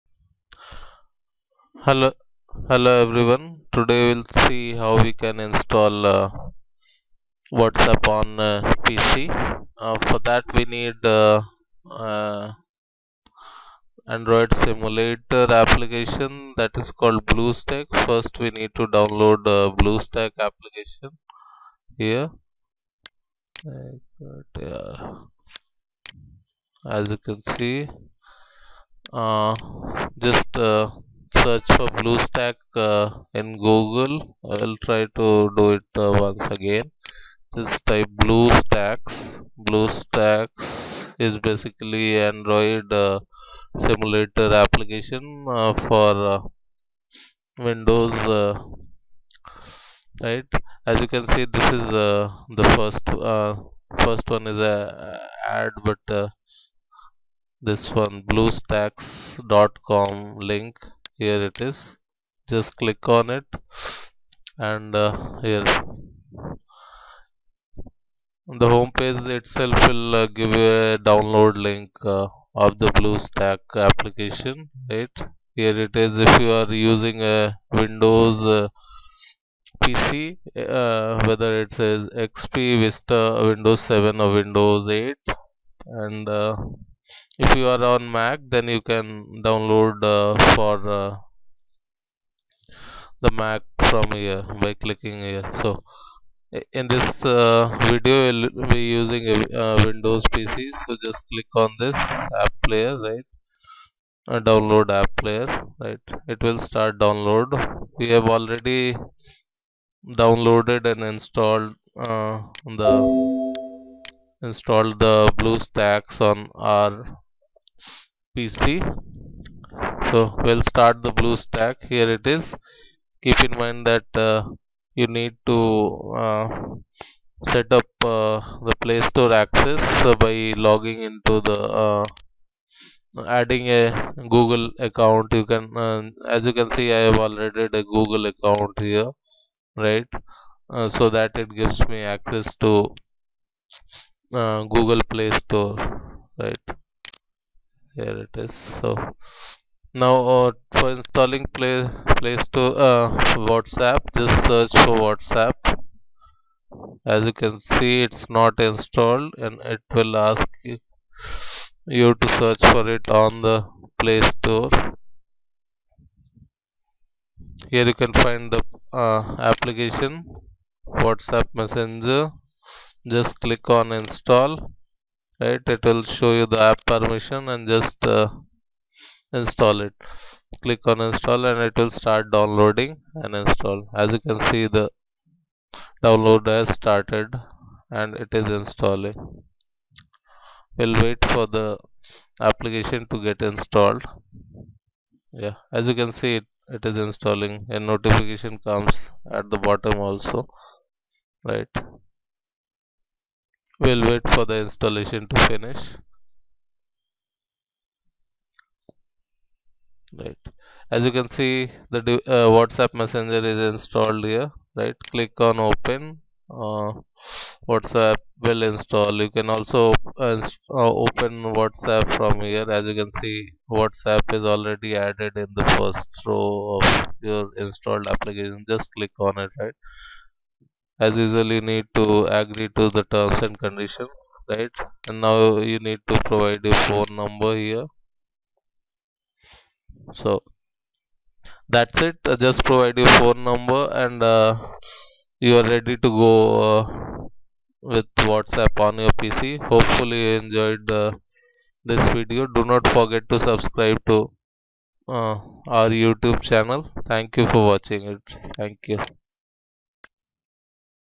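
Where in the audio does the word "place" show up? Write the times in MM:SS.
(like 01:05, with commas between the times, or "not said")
02:32.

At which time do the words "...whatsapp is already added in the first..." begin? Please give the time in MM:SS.
03:43.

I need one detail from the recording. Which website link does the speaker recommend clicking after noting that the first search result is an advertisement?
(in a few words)
bluestacks.com.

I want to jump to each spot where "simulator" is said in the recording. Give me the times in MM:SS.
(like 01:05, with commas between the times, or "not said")
00:14, 00:43.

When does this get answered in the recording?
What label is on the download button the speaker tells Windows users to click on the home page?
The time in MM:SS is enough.
01:44.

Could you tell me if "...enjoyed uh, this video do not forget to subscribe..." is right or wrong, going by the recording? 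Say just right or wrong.
right.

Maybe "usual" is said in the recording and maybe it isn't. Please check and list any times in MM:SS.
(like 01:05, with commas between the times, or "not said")
03:51.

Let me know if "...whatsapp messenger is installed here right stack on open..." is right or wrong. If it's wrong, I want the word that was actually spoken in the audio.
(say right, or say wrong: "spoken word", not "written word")
wrong: "click", not "stack".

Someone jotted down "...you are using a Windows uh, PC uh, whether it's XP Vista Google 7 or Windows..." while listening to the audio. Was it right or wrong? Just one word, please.
wrong.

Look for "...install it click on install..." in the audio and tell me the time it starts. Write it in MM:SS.
02:59.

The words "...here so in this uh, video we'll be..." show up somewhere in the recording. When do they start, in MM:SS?
01:35.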